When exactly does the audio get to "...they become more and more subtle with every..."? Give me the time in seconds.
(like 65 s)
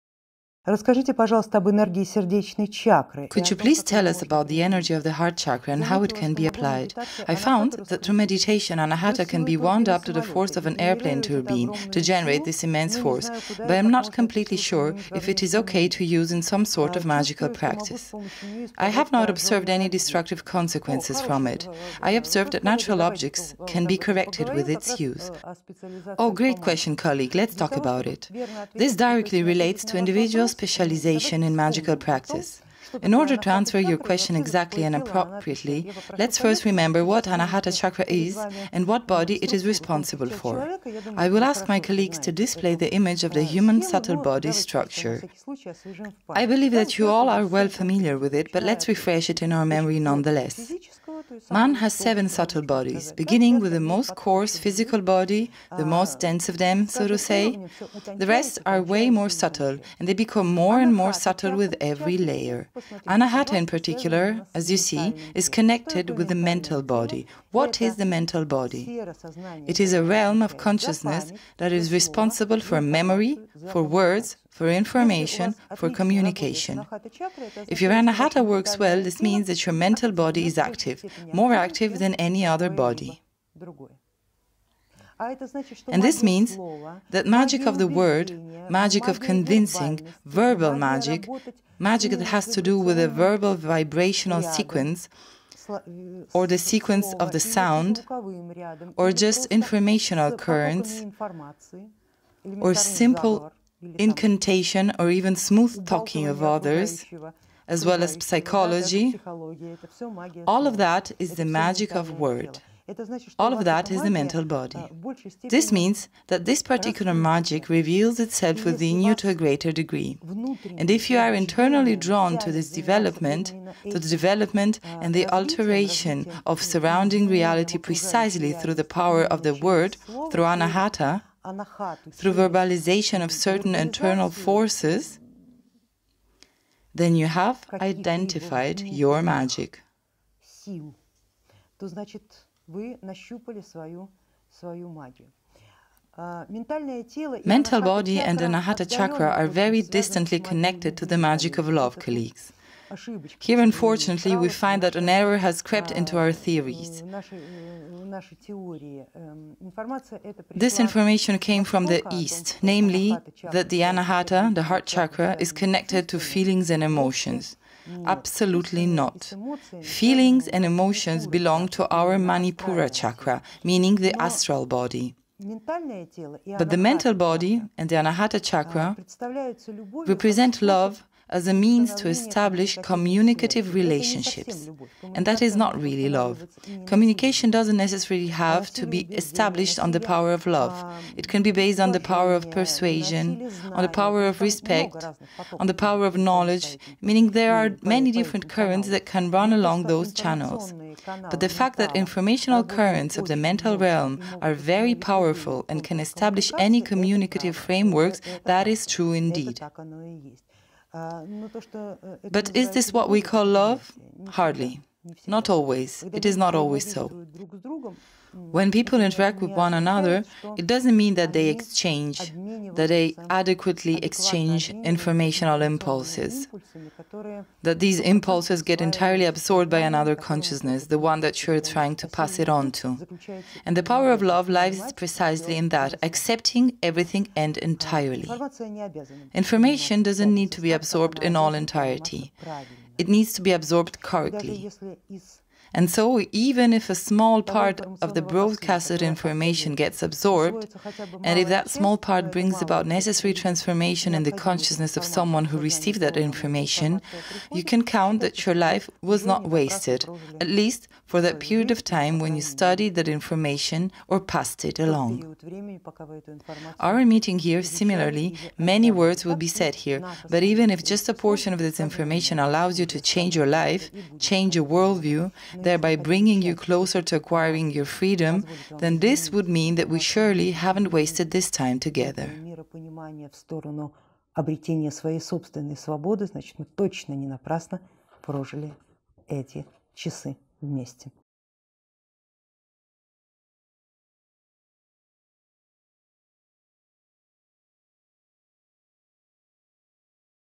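60 s.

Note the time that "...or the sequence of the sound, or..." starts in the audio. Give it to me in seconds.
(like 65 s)
96 s.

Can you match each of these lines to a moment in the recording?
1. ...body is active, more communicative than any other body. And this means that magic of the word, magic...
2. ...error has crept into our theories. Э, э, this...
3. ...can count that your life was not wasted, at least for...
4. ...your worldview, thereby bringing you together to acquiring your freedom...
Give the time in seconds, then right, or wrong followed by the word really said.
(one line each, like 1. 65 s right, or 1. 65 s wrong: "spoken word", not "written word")
1. 80 s wrong: "active", not "communicative"
2. 155 s right
3. 257 s right
4. 274 s wrong: "closer", not "together".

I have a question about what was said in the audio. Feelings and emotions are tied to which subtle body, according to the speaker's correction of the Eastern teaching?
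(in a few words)
Astral body.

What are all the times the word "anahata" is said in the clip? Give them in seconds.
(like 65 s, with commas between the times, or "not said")
8 s, 37 s, 63 s, 77 s, 130 s, 148 s, 163 s, 177 s.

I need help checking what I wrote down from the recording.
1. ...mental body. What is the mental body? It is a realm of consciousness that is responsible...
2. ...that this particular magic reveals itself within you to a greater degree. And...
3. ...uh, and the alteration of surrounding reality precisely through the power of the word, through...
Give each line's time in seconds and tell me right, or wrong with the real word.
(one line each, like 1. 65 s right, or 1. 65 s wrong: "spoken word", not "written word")
1. 66 s right
2. 116 s right
3. 124 s right.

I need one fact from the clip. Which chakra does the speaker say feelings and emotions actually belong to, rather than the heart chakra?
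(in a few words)
Manipura.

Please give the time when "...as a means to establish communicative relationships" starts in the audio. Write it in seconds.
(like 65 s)
181 s.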